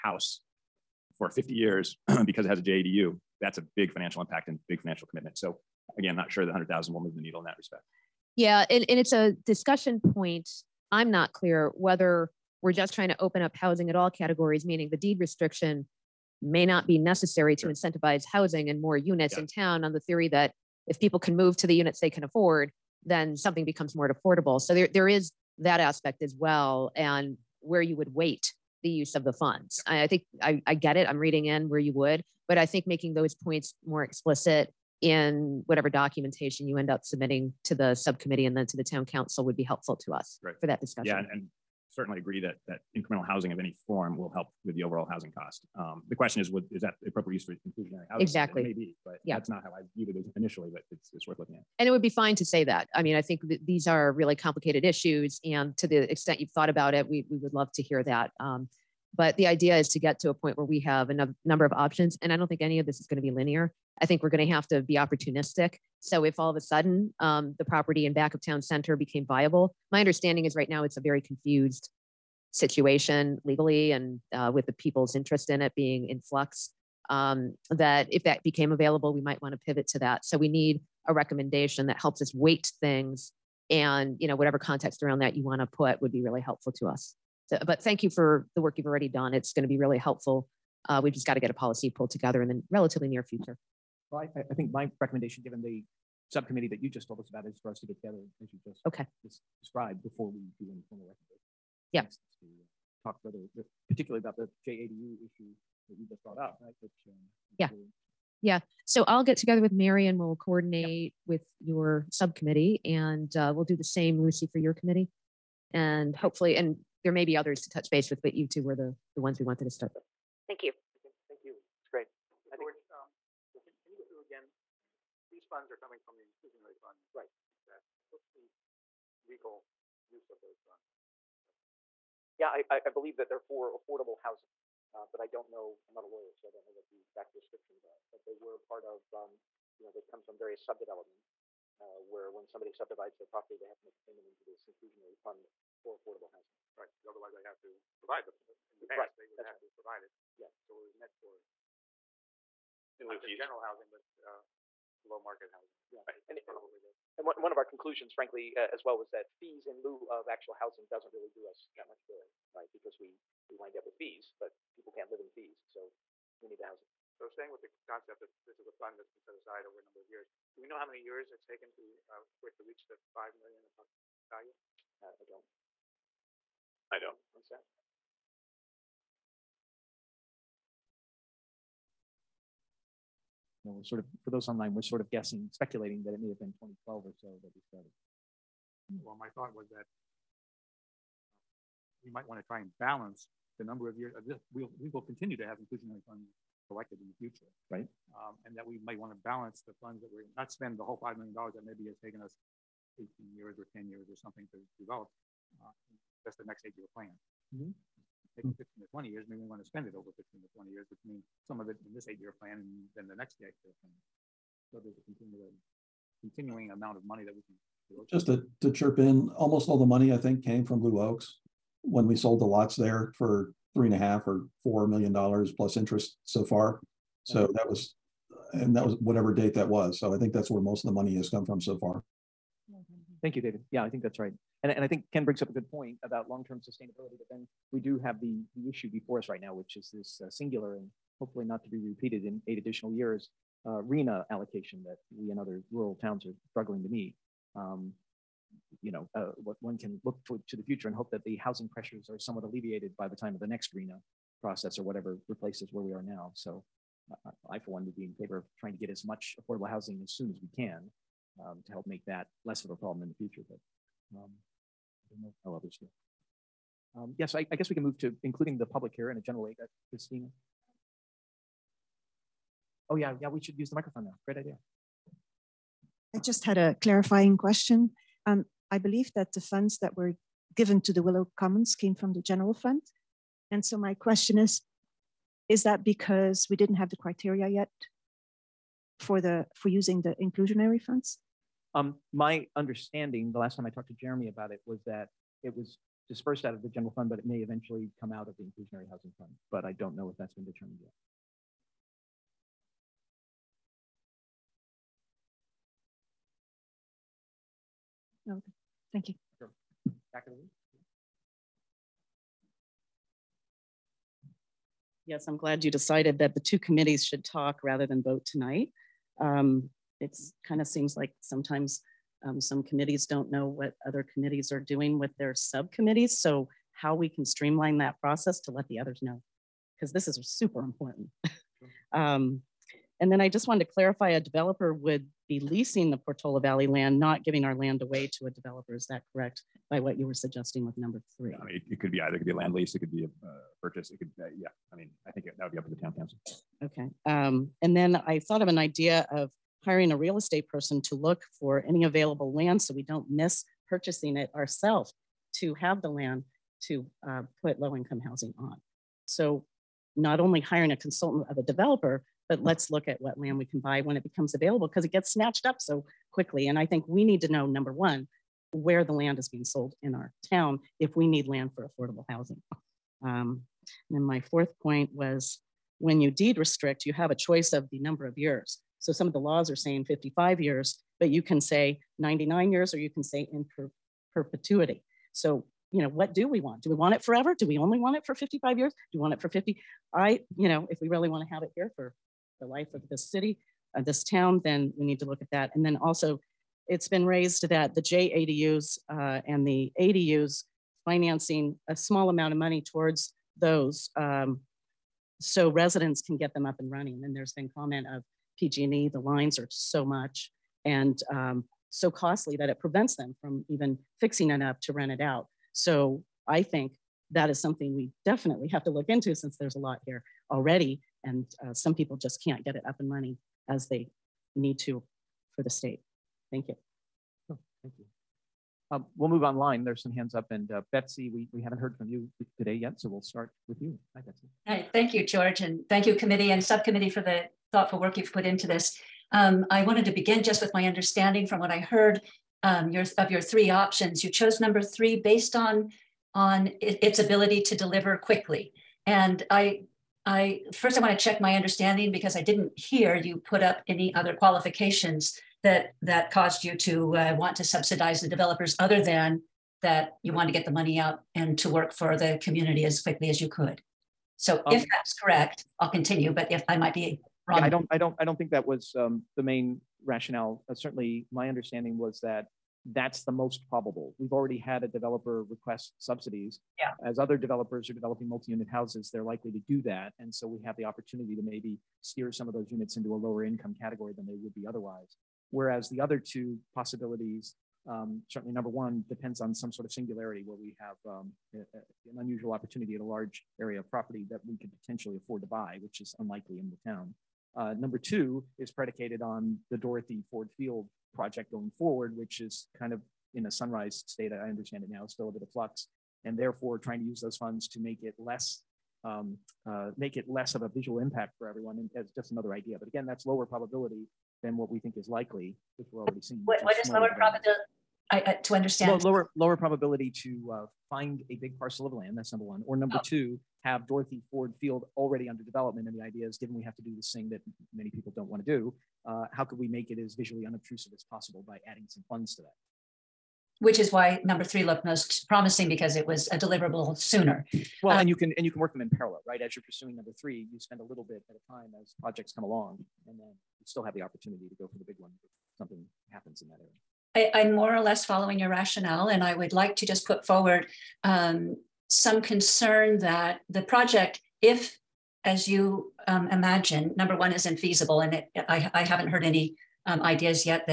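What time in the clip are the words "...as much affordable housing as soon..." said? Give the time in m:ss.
4:18.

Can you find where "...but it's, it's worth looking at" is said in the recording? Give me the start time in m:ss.
0:50.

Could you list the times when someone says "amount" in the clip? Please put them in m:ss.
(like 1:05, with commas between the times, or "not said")
3:36, 6:42.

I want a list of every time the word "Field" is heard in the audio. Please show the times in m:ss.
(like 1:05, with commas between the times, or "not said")
8:20, 8:44.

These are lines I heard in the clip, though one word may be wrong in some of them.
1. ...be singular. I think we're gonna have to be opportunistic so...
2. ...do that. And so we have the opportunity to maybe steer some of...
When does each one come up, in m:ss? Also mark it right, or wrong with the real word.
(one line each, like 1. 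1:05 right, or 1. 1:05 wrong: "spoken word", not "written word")
1. 1:03 wrong: "linear", not "singular"
2. 7:59 right.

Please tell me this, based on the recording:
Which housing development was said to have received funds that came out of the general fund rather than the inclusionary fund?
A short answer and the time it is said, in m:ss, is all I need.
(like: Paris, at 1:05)
Willow Commons, at 4:41.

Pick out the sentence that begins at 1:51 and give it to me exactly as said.
with your subcommittee and uh, we'll do the same, Lucy, for your committee.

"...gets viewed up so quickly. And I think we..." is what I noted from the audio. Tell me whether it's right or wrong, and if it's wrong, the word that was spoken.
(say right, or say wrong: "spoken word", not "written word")
wrong: "snatched", not "viewed".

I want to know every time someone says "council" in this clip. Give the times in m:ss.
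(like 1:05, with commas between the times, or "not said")
0:39, 5:45.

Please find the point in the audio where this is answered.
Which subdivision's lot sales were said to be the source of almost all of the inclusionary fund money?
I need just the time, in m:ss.
3:40.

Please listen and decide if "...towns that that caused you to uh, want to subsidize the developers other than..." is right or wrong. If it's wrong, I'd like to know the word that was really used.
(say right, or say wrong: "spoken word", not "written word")
wrong: "qualifications", not "towns".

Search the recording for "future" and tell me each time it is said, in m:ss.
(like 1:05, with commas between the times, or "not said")
1:33, 3:17, 4:10, 4:23.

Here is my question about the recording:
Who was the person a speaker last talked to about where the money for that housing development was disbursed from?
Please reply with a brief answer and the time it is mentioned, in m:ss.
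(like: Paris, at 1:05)
Jeremy, at 4:54.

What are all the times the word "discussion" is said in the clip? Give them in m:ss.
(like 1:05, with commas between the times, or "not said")
0:09, 0:40.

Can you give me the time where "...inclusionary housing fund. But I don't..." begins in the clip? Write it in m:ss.
4:58.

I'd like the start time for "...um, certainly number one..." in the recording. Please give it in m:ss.
8:07.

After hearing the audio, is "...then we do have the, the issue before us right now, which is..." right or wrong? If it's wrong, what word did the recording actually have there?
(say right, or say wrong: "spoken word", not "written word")
right.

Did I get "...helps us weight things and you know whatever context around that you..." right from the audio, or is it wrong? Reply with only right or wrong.
right.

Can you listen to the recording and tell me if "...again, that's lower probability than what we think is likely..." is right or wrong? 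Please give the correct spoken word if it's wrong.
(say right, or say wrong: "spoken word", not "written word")
right.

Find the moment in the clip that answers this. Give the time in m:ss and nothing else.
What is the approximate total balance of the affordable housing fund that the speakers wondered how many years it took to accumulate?
2:53.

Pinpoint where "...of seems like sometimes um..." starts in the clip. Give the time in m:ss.
5:20.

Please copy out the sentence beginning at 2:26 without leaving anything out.
Right, otherwise they have to provide the, in the past, right.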